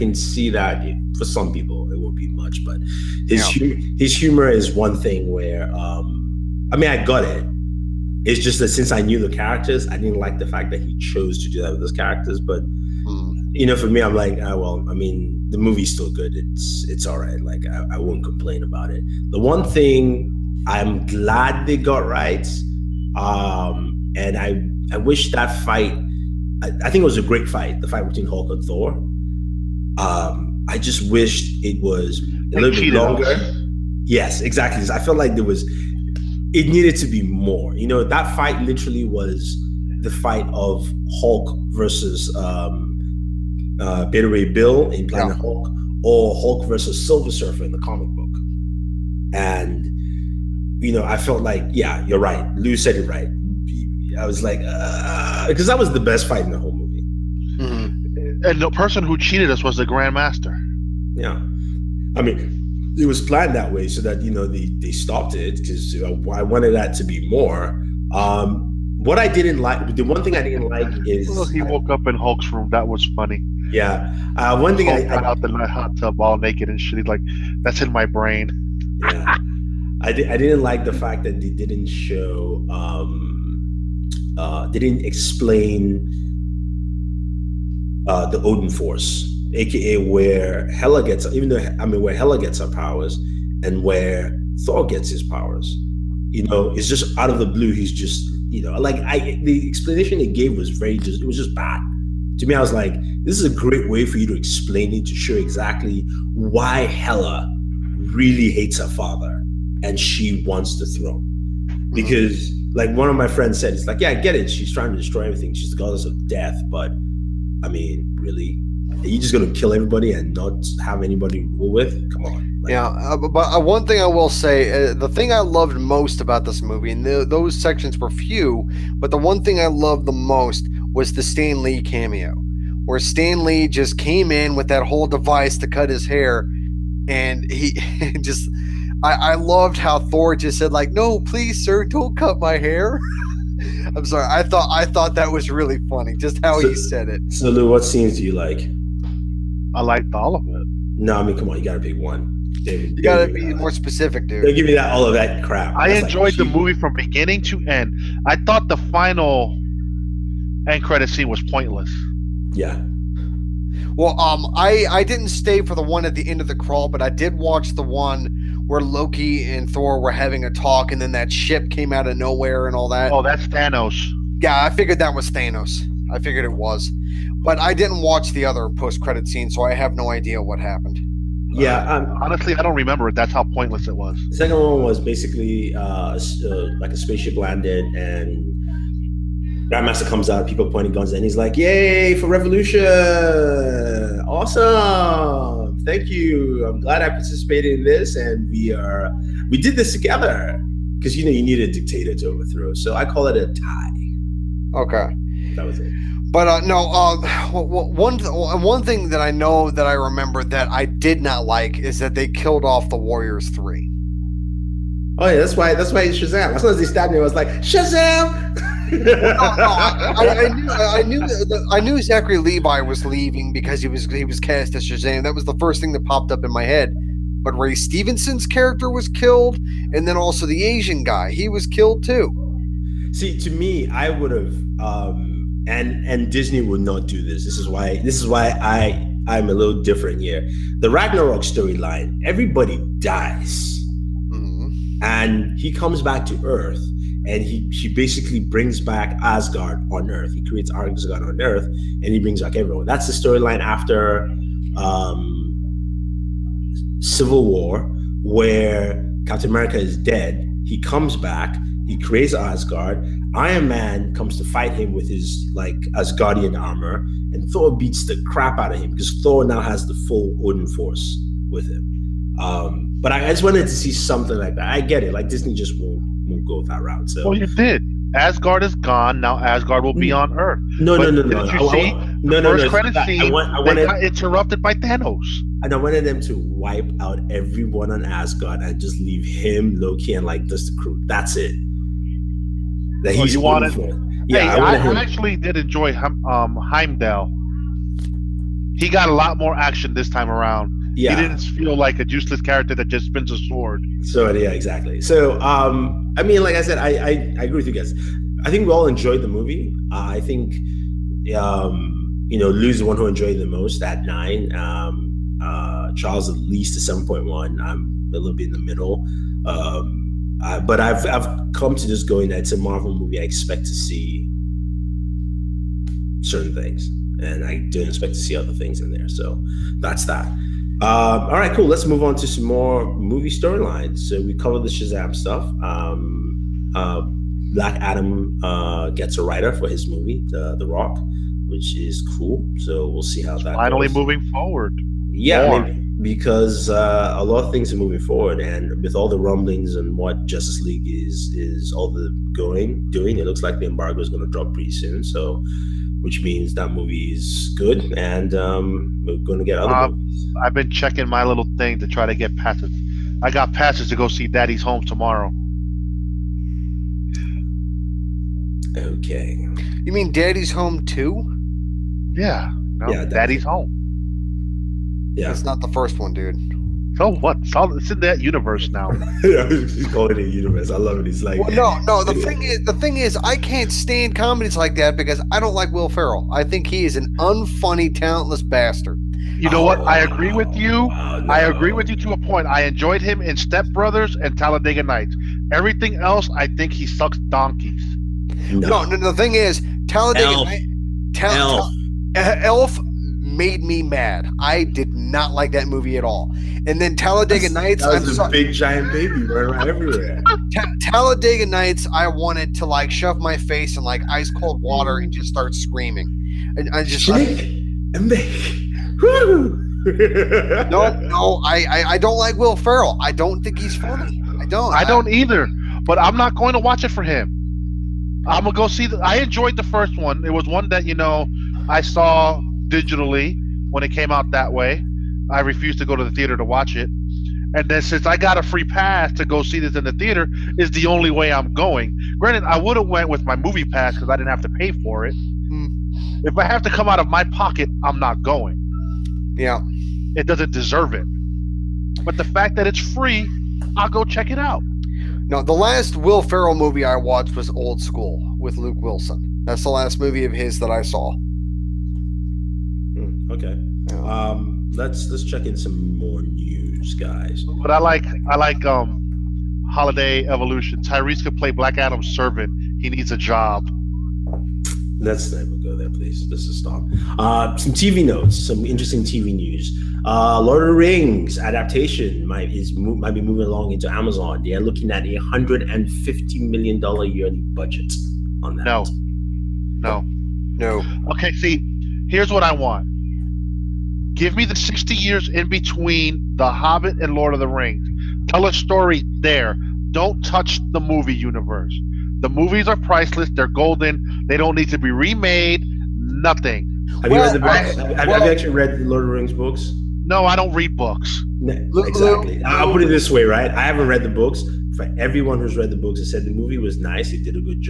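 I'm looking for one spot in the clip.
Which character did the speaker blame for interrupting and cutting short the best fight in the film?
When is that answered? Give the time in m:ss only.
0:59.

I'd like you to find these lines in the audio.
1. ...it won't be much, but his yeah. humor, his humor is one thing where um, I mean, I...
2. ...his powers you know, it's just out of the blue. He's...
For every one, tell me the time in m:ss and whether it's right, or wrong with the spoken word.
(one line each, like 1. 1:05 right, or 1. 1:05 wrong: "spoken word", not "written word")
1. 0:01 right
2. 1:35 right.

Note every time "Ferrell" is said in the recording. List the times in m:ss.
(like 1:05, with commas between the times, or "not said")
6:25, 7:02, 7:36.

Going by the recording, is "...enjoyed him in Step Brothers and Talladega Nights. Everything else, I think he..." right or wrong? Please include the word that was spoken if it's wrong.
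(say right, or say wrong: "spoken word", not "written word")
right.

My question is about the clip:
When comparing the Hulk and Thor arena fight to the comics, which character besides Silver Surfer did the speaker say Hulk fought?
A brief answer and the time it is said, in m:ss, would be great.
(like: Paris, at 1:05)
Beta Ray Bill, at 0:44.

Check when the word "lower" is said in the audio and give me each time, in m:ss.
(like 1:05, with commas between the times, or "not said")
not said.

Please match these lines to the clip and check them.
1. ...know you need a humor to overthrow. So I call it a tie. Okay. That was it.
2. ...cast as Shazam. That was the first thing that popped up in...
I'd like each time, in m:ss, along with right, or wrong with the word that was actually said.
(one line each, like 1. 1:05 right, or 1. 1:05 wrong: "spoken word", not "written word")
1. 3:21 wrong: "dictator", not "humor"
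2. 3:44 right.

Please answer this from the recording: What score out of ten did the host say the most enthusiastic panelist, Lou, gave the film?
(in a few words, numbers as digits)
9.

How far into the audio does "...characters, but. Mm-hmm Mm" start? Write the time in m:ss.
0:11.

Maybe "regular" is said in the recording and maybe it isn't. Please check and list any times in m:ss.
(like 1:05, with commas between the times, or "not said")
not said.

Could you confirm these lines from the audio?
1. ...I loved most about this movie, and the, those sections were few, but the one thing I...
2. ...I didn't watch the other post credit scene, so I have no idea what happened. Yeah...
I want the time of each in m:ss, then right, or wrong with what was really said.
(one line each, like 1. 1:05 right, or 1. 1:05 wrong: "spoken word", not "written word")
1. 2:05 right
2. 2:57 right.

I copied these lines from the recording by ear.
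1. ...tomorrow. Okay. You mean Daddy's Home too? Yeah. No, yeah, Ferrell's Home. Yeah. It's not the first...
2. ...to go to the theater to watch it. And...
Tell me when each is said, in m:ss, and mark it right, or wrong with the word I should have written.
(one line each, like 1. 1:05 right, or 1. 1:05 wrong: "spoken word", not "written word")
1. 6:04 wrong: "Daddy", not "Ferrell"
2. 7:15 right.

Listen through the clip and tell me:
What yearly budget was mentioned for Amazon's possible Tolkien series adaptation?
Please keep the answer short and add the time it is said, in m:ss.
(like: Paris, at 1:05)
$150 million, at 8:05.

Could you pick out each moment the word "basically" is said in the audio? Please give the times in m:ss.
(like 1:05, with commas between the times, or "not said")
3:04, 4:07.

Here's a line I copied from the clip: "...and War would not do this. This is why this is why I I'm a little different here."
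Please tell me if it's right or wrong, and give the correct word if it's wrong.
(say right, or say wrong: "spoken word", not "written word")
wrong: "Disney", not "War".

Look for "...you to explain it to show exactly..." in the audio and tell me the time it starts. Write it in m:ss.
1:44.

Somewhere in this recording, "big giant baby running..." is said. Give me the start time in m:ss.
6:48.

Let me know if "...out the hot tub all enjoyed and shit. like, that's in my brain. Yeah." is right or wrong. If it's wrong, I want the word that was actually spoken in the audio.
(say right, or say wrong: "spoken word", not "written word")
wrong: "naked", not "enjoyed".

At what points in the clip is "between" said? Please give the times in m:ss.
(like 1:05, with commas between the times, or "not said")
0:28, 8:15.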